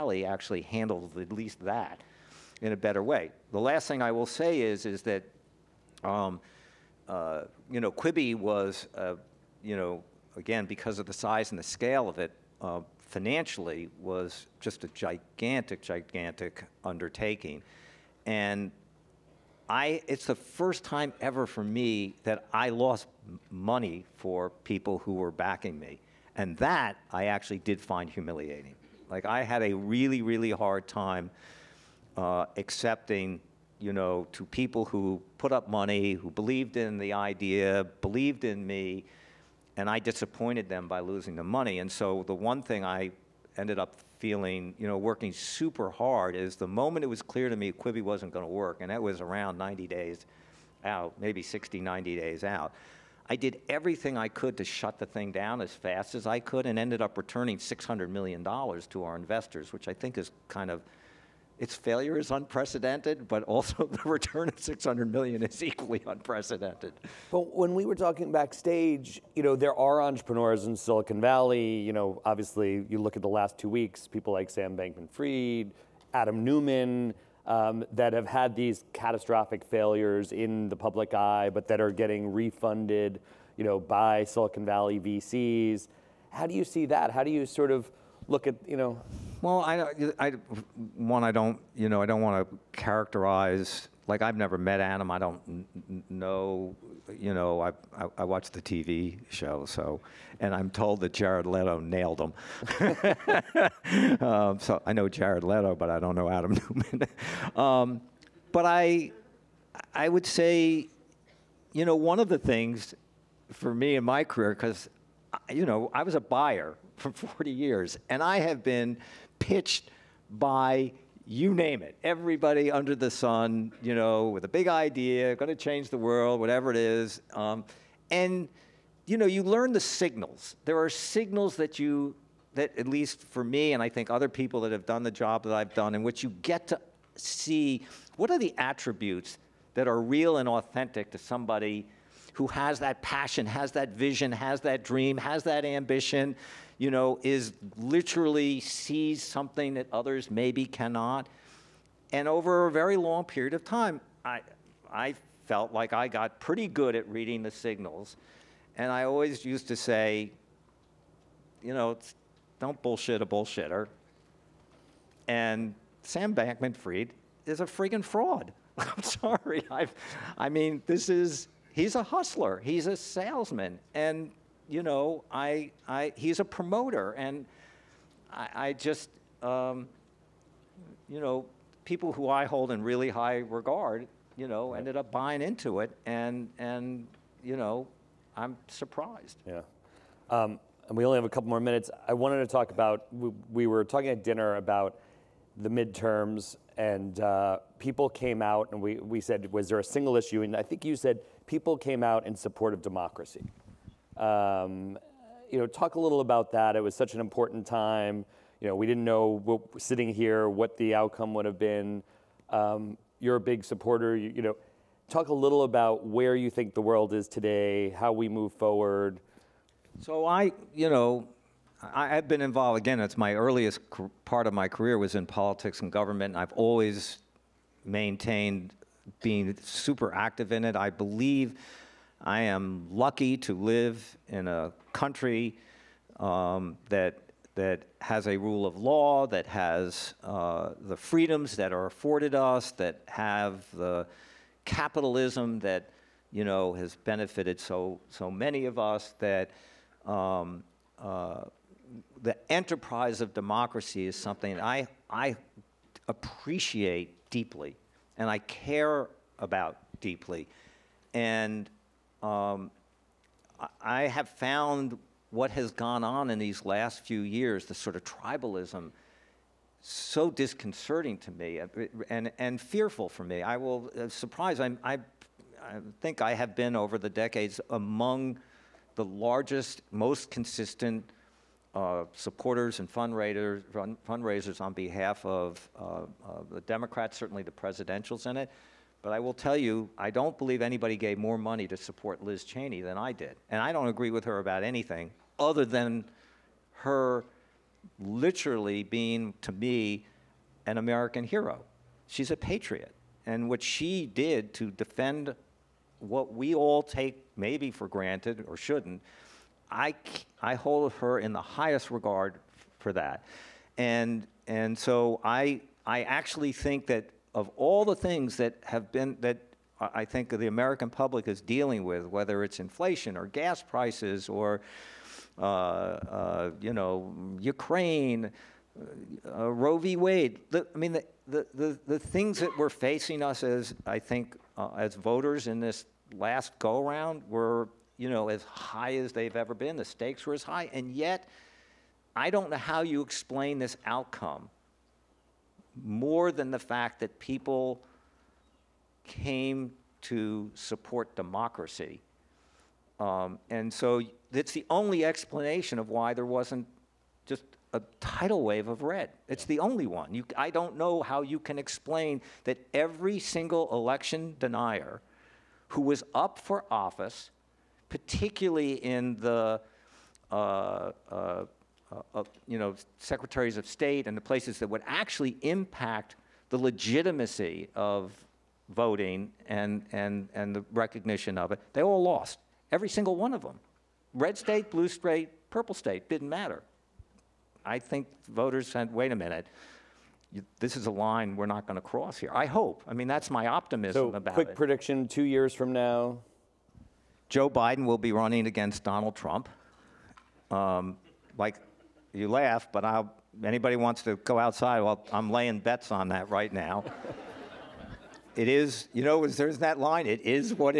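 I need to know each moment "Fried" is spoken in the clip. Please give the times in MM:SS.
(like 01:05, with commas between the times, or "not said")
01:14, 02:46.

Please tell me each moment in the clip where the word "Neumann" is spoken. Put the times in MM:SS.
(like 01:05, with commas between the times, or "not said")
01:16, 01:46.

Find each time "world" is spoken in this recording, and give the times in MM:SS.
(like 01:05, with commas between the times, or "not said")
02:05, 03:36.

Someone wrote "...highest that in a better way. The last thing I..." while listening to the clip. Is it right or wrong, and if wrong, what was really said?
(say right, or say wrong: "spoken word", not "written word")
wrong: "least", not "highest".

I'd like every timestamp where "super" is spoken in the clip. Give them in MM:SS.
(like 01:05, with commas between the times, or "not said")
00:45, 03:49.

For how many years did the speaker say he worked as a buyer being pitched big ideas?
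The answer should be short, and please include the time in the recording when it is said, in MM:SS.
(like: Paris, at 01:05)
40, at 01:57.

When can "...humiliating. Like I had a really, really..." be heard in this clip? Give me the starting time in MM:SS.
00:28.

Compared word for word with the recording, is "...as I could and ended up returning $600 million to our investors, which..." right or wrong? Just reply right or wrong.
right.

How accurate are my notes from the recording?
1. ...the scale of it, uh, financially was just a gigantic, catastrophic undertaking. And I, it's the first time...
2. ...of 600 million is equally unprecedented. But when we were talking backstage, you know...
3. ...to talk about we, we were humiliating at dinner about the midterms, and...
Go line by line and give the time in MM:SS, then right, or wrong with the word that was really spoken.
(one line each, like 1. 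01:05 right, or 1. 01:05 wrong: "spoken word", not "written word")
1. 00:11 wrong: "gigantic", not "catastrophic"
2. 01:04 right
3. 03:12 wrong: "talking", not "humiliating".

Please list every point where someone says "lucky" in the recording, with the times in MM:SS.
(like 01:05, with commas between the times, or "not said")
03:52.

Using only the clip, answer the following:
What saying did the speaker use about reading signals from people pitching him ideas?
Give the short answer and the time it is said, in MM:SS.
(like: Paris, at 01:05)
don't bullshit a bullshitter, at 02:42.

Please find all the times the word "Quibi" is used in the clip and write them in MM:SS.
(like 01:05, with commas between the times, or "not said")
00:07, 00:47.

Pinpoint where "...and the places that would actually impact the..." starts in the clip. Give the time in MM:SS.
06:14.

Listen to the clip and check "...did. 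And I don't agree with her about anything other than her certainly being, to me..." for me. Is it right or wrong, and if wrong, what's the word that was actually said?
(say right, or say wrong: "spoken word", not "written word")
wrong: "literally", not "certainly".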